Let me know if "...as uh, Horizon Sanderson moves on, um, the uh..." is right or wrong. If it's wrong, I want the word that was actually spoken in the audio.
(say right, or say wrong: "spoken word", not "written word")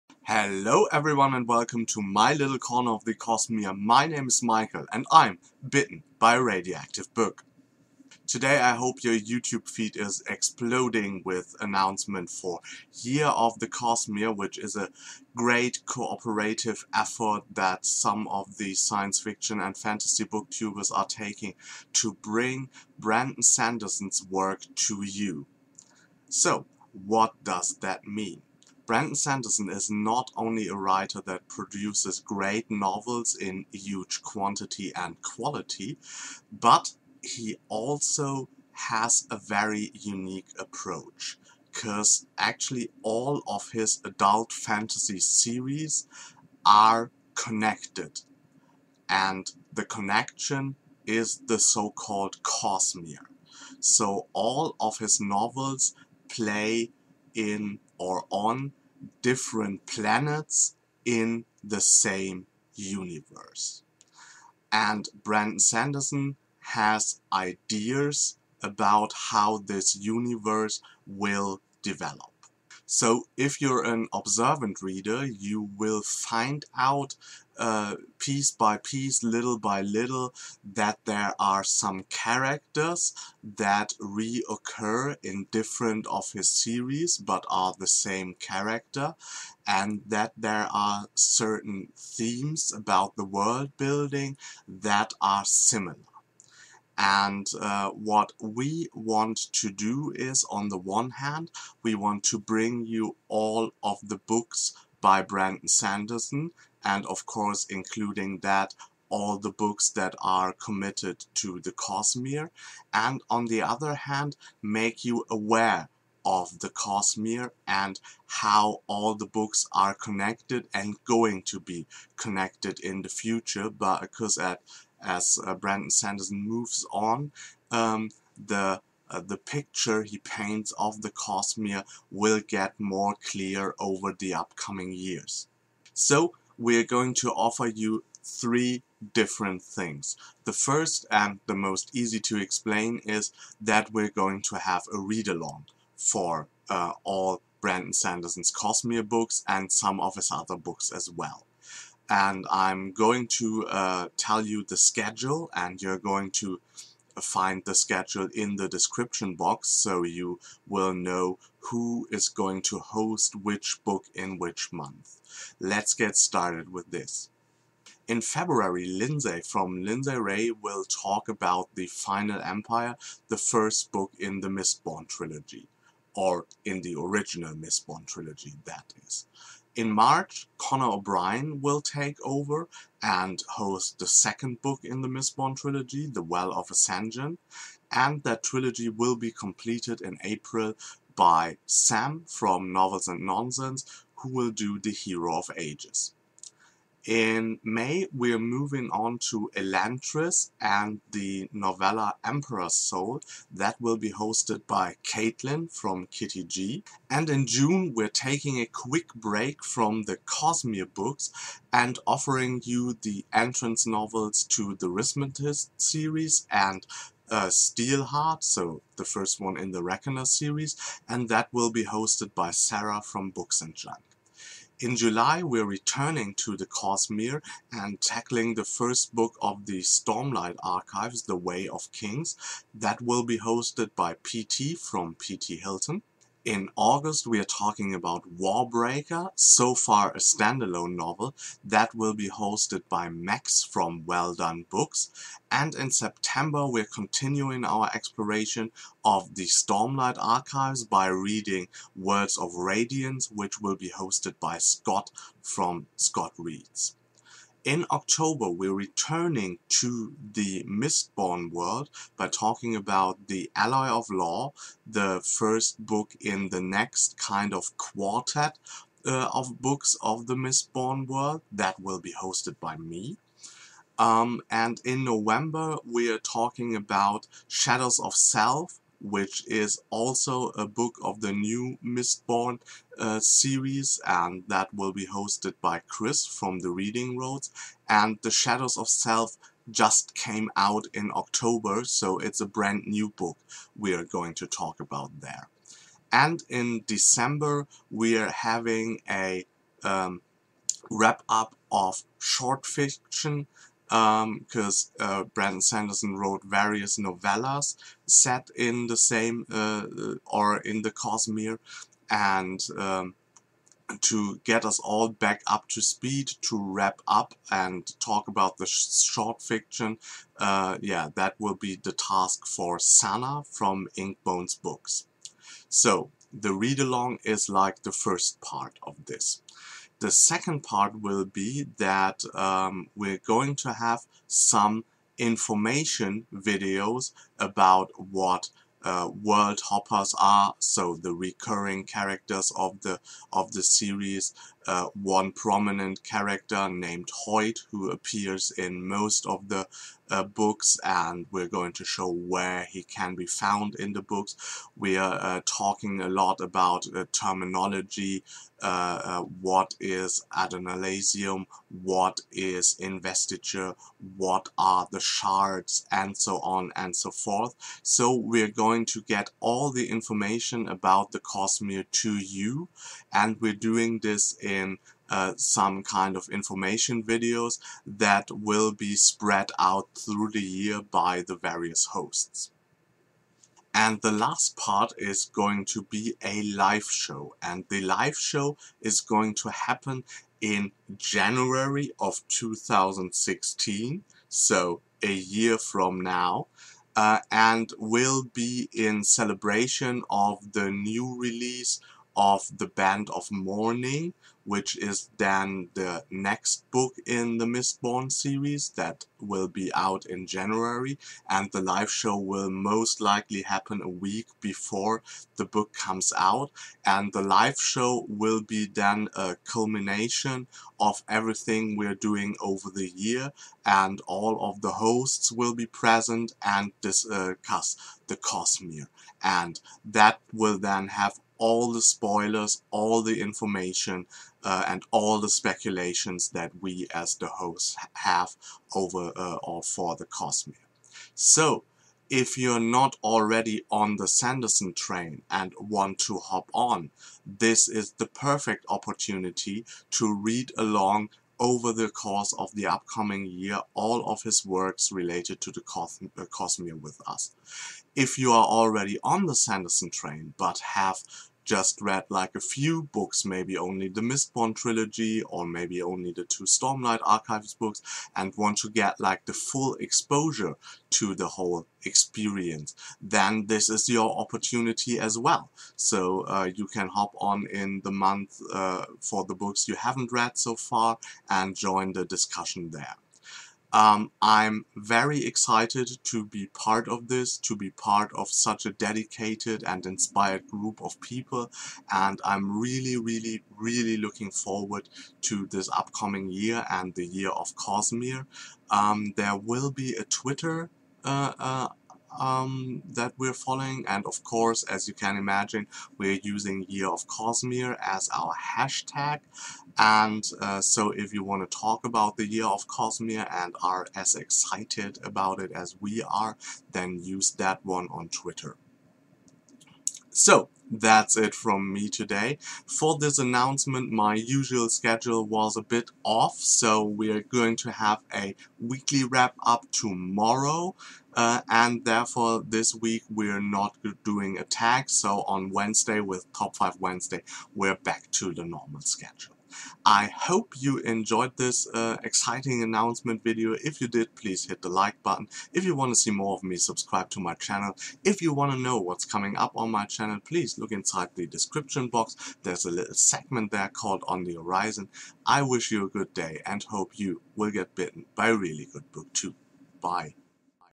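wrong: "Brandon", not "Horizon".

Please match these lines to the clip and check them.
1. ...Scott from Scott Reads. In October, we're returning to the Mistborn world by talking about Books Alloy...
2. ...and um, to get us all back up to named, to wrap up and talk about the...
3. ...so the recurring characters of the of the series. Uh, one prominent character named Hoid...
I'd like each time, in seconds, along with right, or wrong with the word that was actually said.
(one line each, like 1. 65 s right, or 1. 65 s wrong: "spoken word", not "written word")
1. 254 s wrong: "The", not "Books"
2. 312 s wrong: "speed", not "named"
3. 340 s right.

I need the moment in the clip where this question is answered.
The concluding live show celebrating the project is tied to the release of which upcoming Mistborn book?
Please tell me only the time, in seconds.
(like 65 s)
402 s.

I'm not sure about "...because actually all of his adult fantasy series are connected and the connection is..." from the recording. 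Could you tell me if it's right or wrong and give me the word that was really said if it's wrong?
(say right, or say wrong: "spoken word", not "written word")
right.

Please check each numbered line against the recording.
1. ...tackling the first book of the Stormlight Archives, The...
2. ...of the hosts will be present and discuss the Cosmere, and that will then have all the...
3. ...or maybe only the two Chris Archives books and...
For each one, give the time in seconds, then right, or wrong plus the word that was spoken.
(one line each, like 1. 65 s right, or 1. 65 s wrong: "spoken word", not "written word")
1. 228 s right
2. 424 s right
3. 465 s wrong: "Stormlight", not "Chris".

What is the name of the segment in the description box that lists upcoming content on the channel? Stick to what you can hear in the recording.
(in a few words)
On the Horizon.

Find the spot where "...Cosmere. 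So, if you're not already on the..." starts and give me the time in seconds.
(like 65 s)
440 s.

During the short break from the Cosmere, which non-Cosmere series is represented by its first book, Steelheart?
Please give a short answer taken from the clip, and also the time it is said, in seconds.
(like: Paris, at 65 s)
Reckoner series, at 219 s.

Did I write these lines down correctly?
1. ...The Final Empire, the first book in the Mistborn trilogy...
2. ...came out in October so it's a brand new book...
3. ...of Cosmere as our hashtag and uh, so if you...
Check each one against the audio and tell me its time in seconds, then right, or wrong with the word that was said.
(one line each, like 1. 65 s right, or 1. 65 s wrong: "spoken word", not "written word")
1. 171 s right
2. 290 s right
3. 506 s right.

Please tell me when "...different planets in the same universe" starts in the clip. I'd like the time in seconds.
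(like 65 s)
59 s.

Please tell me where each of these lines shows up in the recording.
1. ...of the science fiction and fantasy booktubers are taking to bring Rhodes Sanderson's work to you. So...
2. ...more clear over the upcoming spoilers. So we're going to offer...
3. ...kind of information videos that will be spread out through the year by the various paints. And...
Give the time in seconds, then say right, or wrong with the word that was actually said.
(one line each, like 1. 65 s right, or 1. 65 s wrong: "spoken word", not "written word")
1. 18 s wrong: "Brandon", not "Rhodes"
2. 132 s wrong: "years", not "spoilers"
3. 375 s wrong: "hosts", not "paints".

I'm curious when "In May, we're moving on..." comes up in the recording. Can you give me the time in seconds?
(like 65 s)
197 s.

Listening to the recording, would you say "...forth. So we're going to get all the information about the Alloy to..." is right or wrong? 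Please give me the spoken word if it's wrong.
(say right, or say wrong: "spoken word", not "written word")
wrong: "Cosmere", not "Alloy".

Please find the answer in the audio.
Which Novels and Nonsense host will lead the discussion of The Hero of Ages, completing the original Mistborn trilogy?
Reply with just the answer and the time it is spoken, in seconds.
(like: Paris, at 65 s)
Sam, at 191 s.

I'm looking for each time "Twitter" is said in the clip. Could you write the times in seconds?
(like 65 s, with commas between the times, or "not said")
500 s, 518 s.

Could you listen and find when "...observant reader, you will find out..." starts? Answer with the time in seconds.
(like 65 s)
74 s.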